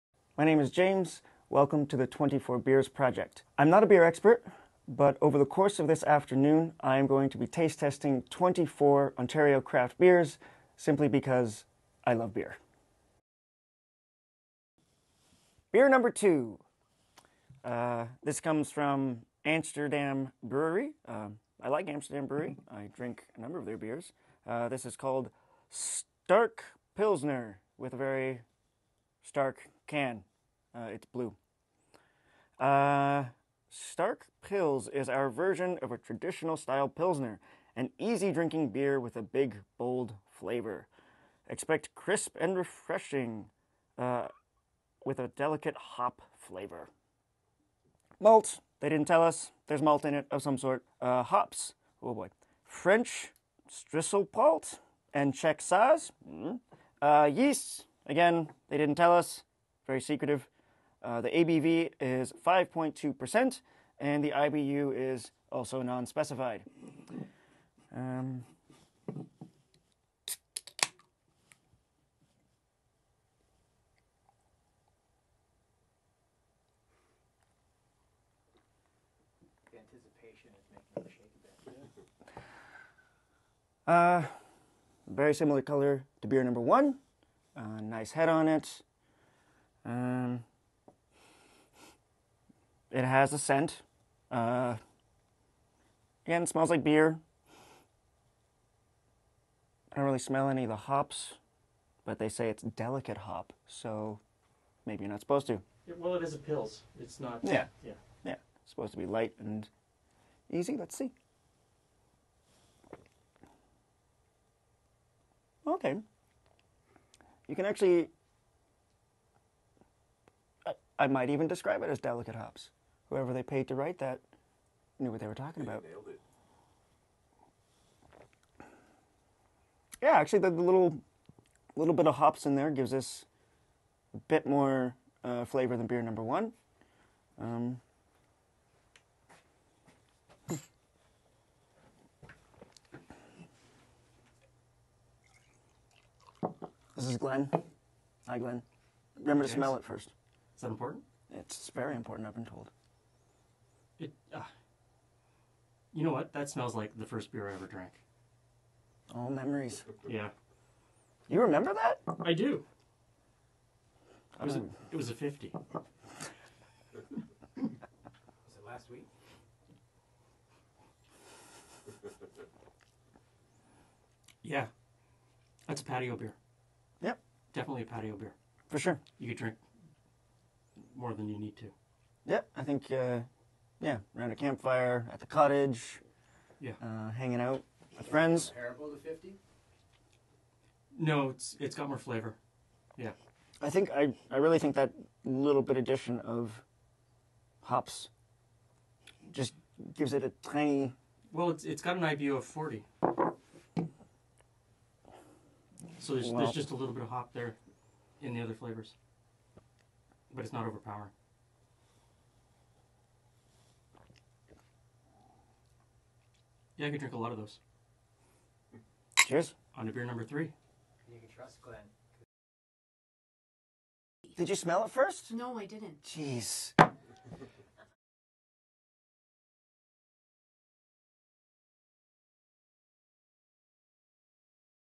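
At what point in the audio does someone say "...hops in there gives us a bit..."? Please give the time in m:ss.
2:12.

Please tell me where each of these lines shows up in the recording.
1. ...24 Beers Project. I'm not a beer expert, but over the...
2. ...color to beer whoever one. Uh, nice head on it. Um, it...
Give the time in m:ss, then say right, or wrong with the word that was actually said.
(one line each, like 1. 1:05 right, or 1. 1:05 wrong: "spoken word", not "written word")
1. 0:02 right
2. 1:25 wrong: "number", not "whoever".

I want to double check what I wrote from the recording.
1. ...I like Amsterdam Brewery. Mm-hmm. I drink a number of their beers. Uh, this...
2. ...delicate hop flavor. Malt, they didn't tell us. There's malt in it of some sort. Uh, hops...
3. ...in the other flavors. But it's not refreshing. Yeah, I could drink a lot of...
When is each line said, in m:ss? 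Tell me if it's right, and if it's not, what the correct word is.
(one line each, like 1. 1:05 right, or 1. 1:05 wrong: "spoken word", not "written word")
1. 0:21 right
2. 0:45 right
3. 3:28 wrong: "overpowering", not "refreshing".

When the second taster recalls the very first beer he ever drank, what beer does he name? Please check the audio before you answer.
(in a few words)
50.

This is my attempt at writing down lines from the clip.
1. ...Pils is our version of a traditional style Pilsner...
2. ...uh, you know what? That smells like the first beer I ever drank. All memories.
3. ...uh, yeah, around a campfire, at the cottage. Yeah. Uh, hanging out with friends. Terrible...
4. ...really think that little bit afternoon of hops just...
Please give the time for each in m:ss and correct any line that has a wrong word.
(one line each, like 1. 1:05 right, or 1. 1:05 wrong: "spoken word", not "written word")
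1. 0:34 right
2. 2:34 right
3. 3:02 right
4. 3:14 wrong: "addition", not "afternoon".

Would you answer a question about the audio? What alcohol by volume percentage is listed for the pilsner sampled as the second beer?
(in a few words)
5.2%.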